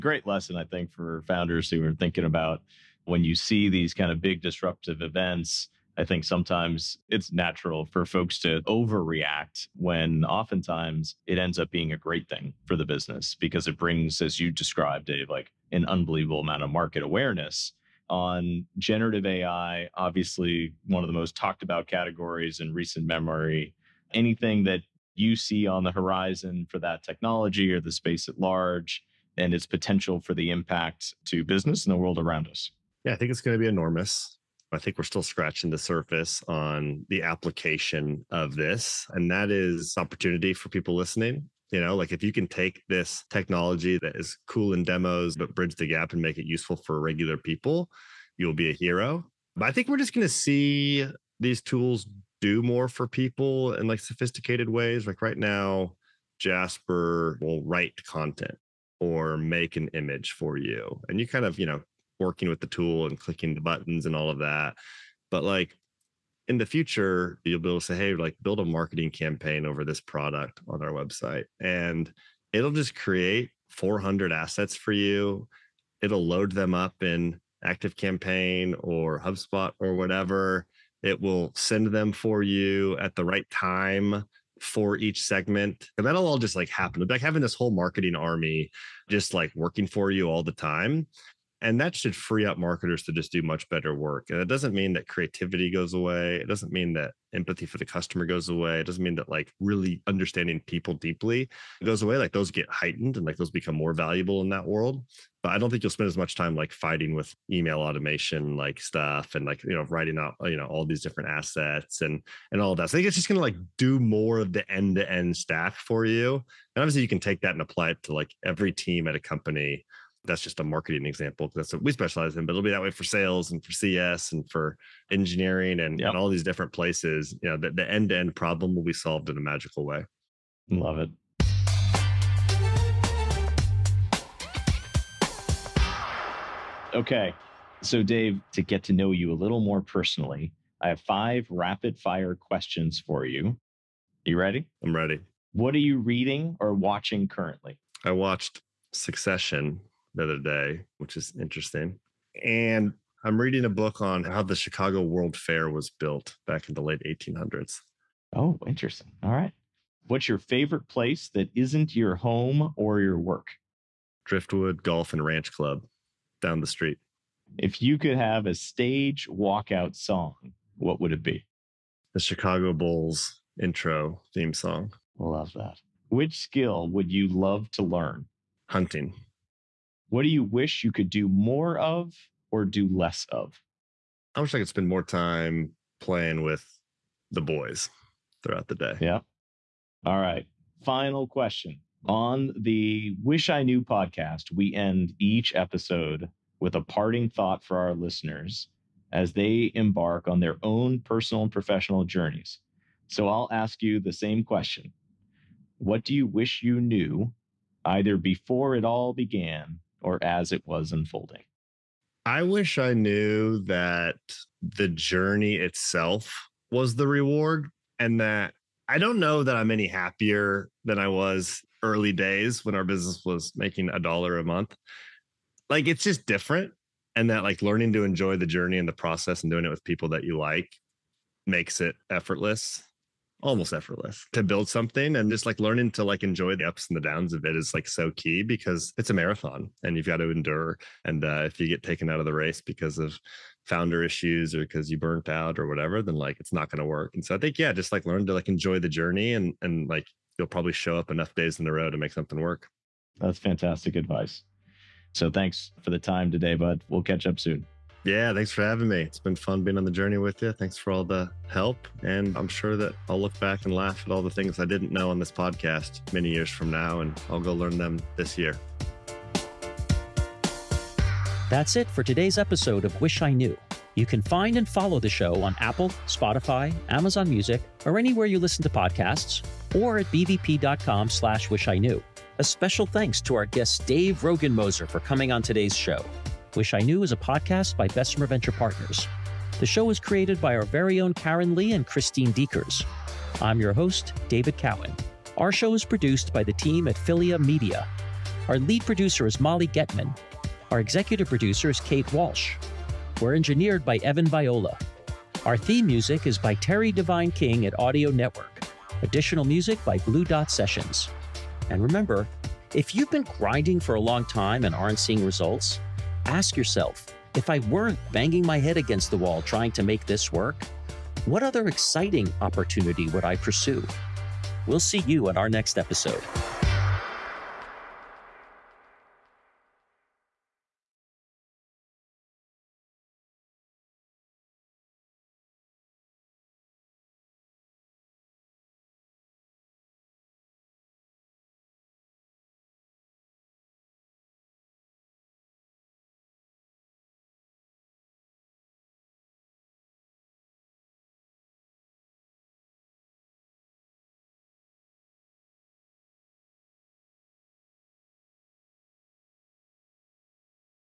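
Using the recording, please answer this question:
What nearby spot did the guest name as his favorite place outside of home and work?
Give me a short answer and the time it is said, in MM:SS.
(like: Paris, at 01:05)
Driftwood Golf and Ranch Club, at 02:44.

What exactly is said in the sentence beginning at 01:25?
And that'll all just like happen.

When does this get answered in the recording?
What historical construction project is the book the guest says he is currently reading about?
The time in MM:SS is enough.
02:34.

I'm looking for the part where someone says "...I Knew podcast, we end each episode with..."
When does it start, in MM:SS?
03:13.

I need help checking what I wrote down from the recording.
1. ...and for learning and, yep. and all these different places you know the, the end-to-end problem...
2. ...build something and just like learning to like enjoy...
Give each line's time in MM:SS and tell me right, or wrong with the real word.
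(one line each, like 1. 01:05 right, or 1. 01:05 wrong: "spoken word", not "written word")
1. 02:04 wrong: "engineering", not "learning"
2. 03:54 right.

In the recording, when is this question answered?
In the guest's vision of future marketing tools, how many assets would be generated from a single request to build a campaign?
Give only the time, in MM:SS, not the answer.
01:13.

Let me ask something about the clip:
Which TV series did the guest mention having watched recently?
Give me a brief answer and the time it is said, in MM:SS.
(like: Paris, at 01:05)
Succession, at 02:28.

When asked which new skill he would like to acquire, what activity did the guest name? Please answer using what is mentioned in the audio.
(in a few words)
Hunting.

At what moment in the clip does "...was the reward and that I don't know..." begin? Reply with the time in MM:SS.
03:36.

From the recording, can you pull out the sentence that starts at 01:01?
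And you kind of, you know, working with the tool and clicking the buttons and all of that.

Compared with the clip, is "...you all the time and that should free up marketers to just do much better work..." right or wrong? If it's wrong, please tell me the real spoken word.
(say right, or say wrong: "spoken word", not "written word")
right.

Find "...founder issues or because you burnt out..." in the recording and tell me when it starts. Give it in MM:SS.
04:03.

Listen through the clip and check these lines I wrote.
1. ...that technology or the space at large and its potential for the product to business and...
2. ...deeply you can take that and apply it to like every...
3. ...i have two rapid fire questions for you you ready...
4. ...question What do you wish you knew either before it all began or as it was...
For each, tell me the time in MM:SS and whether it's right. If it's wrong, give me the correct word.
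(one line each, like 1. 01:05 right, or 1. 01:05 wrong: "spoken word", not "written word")
1. 00:26 wrong: "impact", not "product"
2. 01:56 wrong: "obviously", not "deeply"
3. 02:20 wrong: "five", not "two"
4. 03:24 right.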